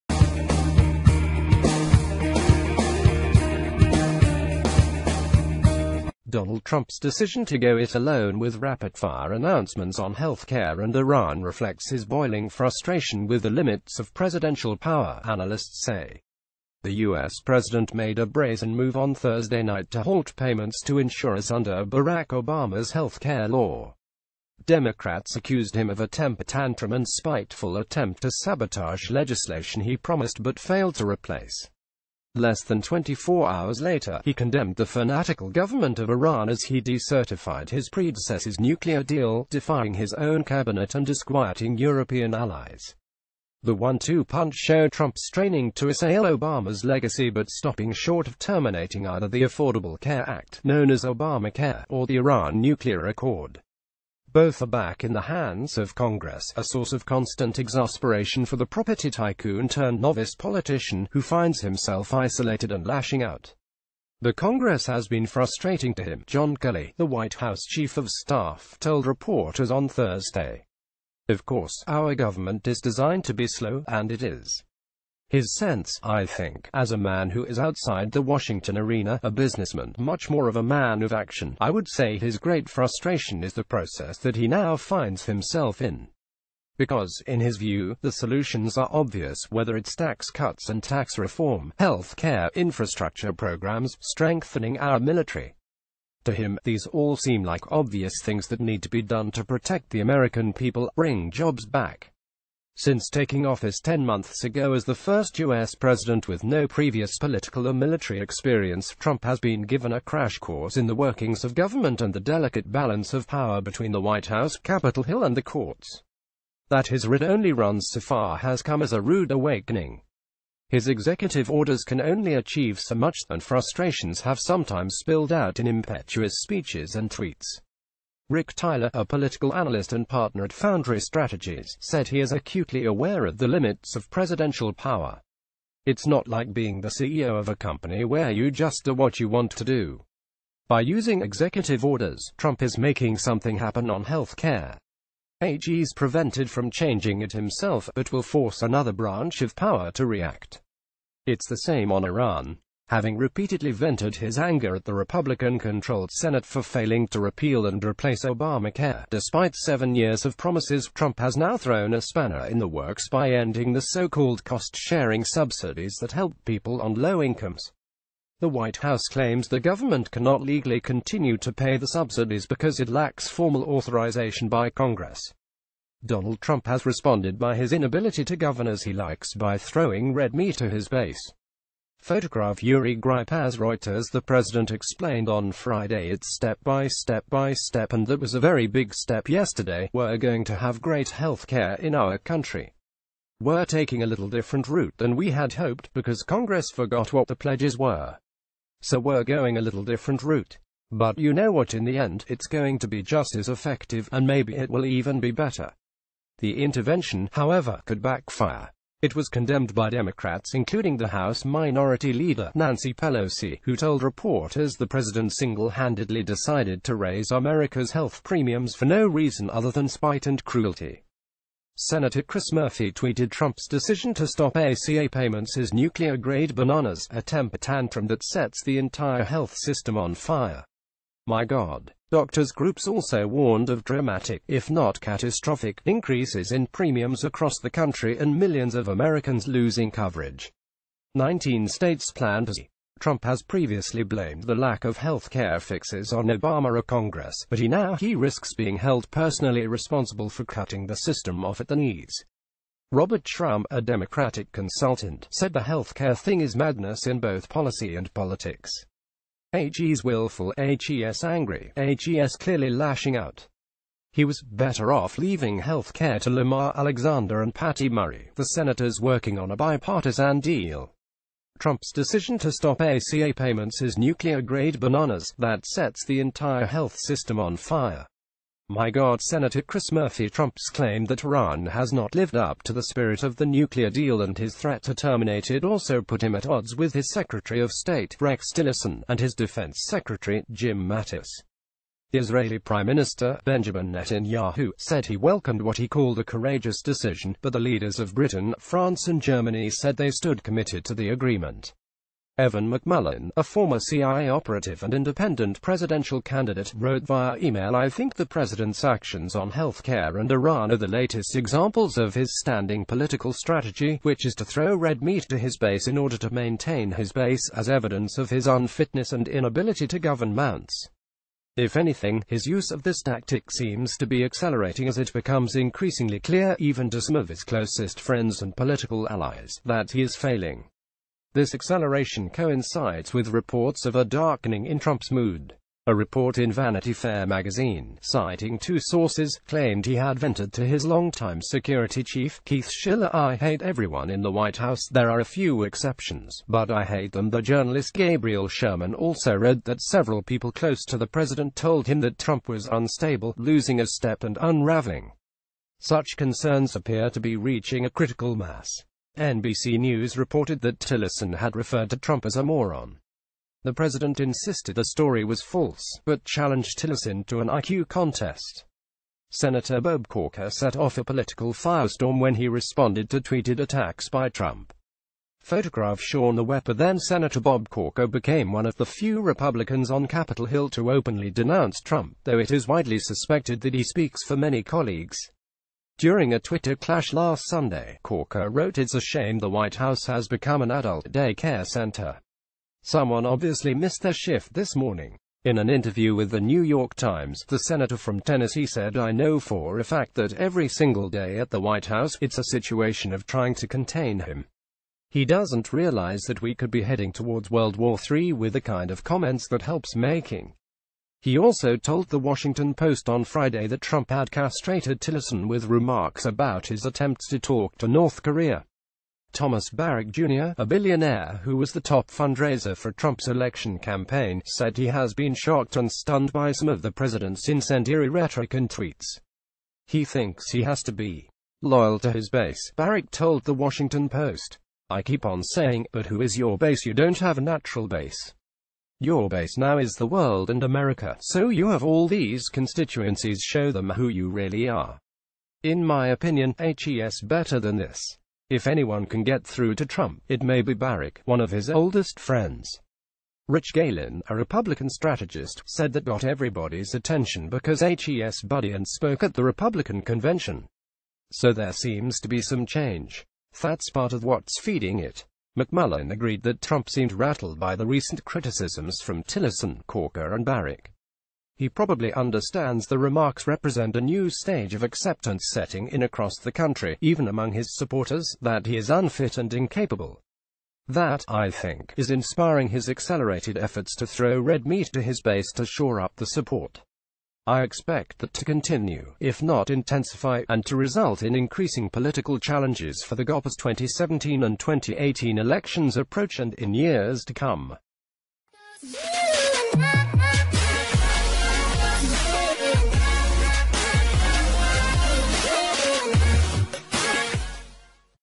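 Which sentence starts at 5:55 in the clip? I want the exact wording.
Such concerns appear to be reaching a critical mass.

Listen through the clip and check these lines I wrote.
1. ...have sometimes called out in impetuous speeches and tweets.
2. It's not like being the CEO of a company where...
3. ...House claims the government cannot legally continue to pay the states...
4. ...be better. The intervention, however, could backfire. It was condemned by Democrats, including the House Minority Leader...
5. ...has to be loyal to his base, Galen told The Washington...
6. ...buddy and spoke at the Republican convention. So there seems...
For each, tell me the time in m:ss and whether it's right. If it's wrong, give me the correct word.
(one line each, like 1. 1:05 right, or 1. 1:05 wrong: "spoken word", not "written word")
1. 2:04 wrong: "spilled", not "called"
2. 2:15 right
3. 2:48 wrong: "subsidies", not "states"
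4. 3:25 right
5. 7:10 wrong: "Barrack", not "Galen"
6. 7:38 right.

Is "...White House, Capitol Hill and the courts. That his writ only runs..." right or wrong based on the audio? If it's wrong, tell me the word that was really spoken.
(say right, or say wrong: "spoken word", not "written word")
right.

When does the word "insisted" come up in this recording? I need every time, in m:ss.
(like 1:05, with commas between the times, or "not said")
6:04.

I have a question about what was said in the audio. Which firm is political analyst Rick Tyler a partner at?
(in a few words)
Foundry Strategies.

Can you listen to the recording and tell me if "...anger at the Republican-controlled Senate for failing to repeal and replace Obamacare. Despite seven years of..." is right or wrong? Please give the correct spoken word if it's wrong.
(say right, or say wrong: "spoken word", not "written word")
right.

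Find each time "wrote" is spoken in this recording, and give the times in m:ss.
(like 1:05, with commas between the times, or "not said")
5:06, 6:28.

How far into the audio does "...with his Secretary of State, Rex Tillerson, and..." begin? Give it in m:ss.
4:46.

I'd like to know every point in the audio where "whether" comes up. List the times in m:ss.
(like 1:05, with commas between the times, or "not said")
1:29.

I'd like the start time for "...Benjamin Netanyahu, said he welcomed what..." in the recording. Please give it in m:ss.
4:53.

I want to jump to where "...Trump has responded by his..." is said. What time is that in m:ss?
2:56.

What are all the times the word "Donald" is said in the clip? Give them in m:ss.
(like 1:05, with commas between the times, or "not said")
0:06, 2:56.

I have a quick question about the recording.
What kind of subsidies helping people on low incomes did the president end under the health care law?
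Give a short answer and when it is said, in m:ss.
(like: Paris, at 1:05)
cost-sharing subsidies, at 2:44.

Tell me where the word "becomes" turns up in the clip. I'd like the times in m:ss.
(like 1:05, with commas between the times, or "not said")
5:25, 6:30.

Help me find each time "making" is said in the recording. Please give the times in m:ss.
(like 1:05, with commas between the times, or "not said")
2:22, 6:49.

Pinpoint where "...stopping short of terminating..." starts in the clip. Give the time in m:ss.
0:47.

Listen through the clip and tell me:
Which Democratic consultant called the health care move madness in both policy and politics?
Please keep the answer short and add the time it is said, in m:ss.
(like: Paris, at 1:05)
Robert Shrum, at 4:12.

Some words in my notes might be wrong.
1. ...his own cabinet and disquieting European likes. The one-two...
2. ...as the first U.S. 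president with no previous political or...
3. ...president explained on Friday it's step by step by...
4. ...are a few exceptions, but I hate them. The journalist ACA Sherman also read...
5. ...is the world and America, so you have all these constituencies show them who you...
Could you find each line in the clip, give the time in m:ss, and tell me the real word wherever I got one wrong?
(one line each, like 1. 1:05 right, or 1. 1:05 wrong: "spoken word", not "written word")
1. 0:39 wrong: "allies", not "likes"
2. 1:44 right
3. 3:04 right
4. 5:45 wrong: "Gabriel", not "ACA"
5. 7:19 right.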